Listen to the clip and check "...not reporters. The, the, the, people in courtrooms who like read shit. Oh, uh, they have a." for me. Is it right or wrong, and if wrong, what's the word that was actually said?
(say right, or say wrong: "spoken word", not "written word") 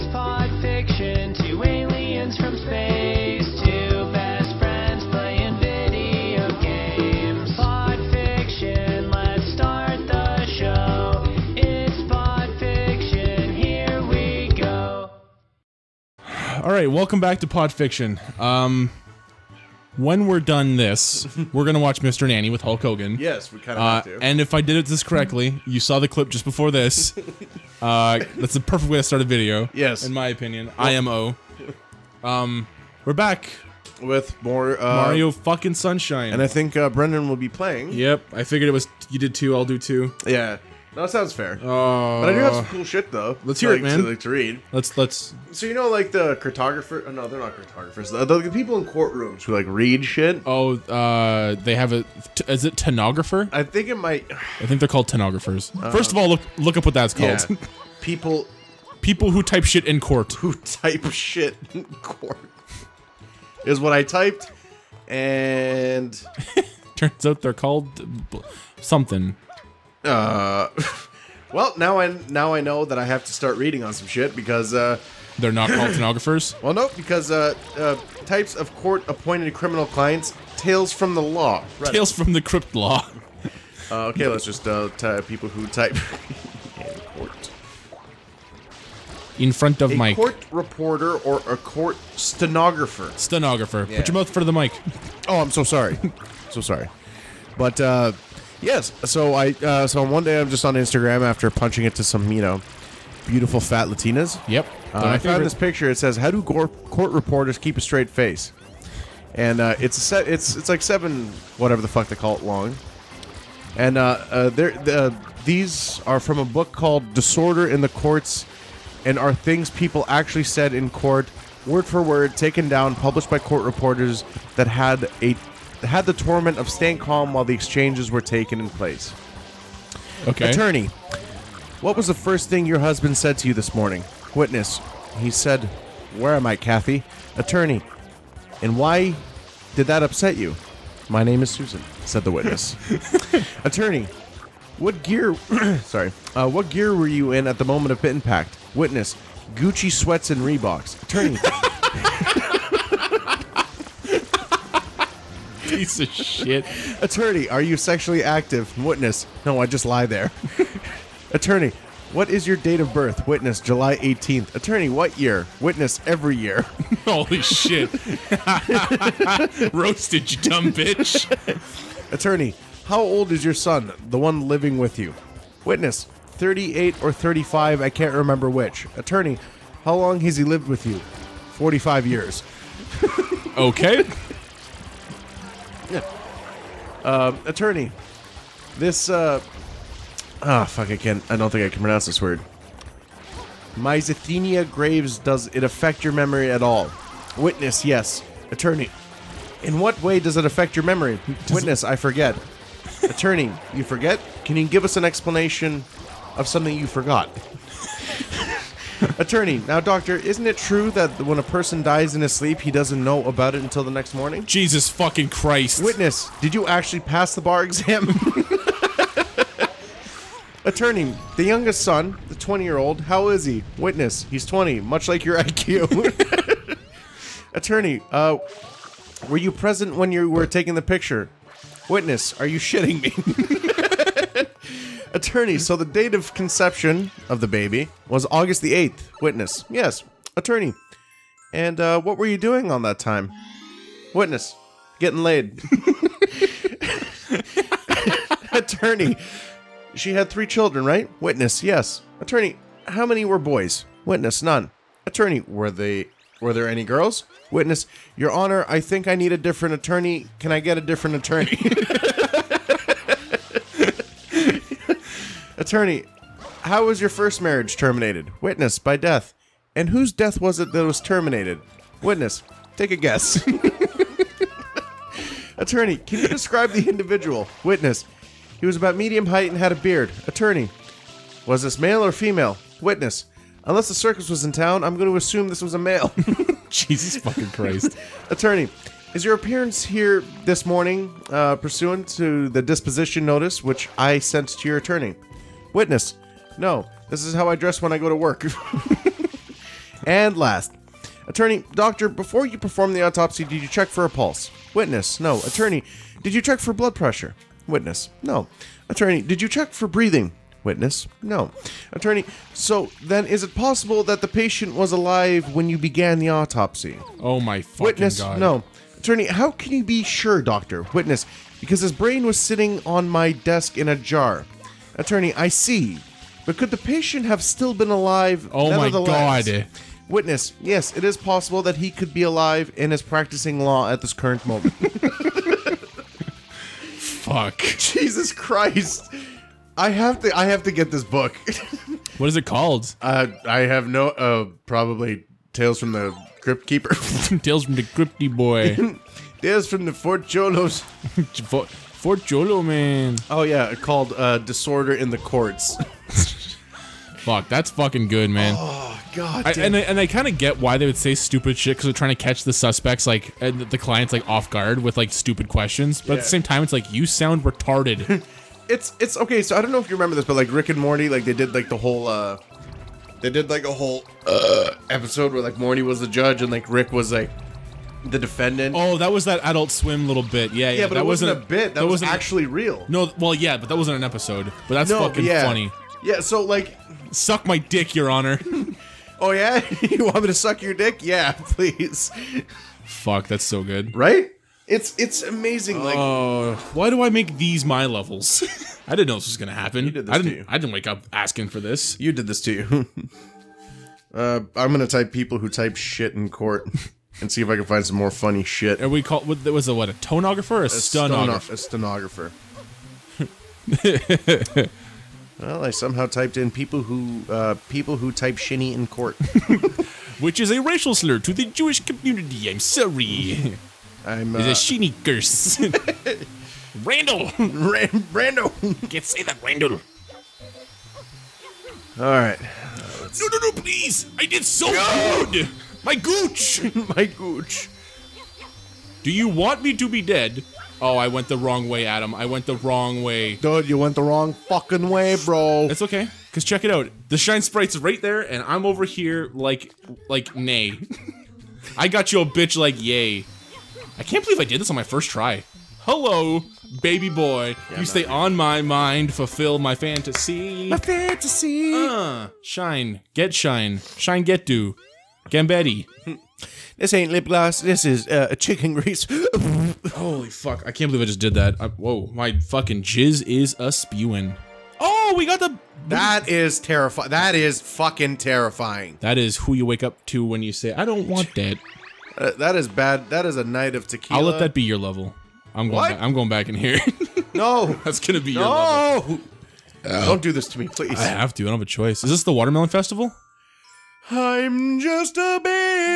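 wrong: "cartographers", not "reporters".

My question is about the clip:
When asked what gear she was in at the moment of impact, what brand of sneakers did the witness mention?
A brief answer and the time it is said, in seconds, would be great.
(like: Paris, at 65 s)
Reeboks, at 150 s.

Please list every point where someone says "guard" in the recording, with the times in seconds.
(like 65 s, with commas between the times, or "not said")
364 s.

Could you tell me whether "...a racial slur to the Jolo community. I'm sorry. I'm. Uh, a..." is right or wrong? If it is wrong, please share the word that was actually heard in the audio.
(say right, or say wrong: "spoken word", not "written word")
wrong: "Jewish", not "Jolo".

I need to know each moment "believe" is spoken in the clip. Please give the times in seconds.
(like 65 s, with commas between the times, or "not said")
454 s, 470 s.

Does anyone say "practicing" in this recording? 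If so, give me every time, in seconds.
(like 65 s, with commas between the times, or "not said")
333 s.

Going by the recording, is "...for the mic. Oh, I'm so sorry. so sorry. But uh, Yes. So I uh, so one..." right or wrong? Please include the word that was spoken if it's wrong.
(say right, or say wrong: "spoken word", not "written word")
right.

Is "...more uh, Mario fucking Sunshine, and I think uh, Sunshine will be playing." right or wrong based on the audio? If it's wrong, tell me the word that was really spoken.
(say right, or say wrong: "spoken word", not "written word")
wrong: "Brendan", not "Sunshine".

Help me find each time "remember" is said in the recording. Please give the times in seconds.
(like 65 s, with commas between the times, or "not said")
178 s, 369 s.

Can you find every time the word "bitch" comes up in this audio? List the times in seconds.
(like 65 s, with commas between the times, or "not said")
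170 s, 452 s.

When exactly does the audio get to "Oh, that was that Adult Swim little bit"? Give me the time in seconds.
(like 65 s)
378 s.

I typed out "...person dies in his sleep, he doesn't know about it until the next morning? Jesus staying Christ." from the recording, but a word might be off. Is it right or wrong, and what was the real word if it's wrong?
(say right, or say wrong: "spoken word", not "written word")
wrong: "fucking", not "staying".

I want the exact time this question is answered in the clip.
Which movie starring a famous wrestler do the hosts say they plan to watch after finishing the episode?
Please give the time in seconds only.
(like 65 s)
21 s.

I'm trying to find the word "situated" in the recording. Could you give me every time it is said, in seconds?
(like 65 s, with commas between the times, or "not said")
not said.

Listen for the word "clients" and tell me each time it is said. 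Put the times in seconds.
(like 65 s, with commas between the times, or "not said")
79 s, 363 s.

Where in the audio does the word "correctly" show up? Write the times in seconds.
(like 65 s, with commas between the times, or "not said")
25 s.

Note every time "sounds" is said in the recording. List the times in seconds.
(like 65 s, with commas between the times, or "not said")
41 s, 367 s.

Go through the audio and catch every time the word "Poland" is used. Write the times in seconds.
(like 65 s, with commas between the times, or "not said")
not said.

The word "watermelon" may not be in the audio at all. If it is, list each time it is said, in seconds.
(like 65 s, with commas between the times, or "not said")
492 s.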